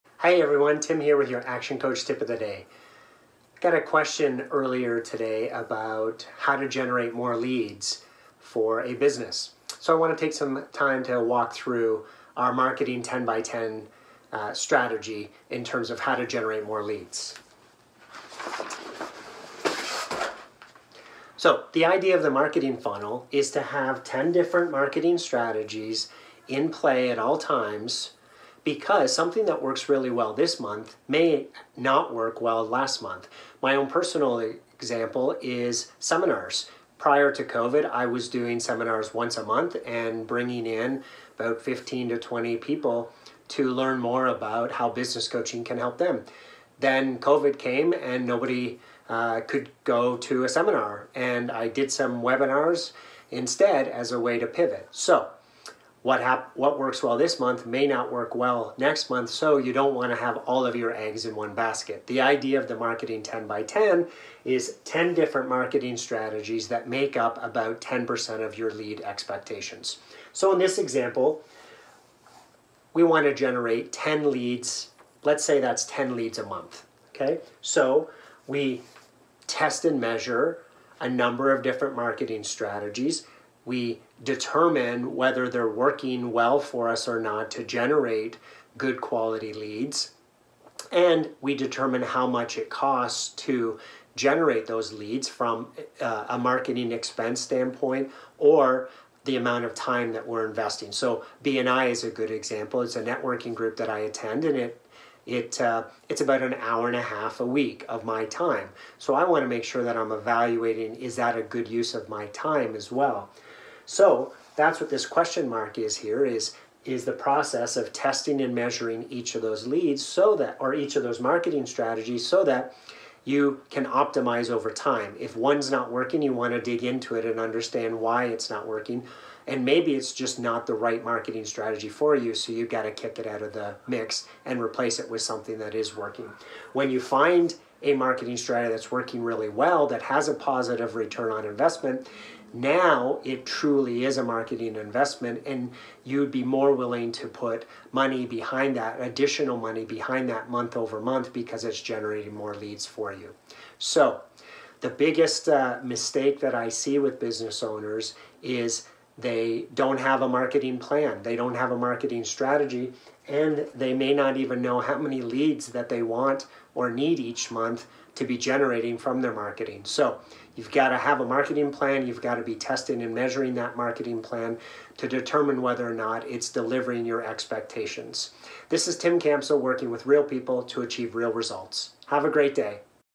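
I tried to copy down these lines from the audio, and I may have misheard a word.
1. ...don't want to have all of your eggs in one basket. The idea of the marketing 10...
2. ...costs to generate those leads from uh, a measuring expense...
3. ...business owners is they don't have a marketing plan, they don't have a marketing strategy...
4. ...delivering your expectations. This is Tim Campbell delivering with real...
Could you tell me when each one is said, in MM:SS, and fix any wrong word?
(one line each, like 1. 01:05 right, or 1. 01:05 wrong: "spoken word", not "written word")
1. 00:59 right
2. 01:32 wrong: "marketing", not "measuring"
3. 02:37 right
4. 02:56 wrong: "working", not "delivering".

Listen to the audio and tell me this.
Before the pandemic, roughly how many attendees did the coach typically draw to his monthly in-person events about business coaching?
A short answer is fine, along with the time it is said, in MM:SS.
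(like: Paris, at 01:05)
15 to 20, at 00:41.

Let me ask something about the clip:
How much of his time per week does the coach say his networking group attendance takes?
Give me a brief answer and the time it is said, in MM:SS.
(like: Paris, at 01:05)
An hour and a half, at 01:46.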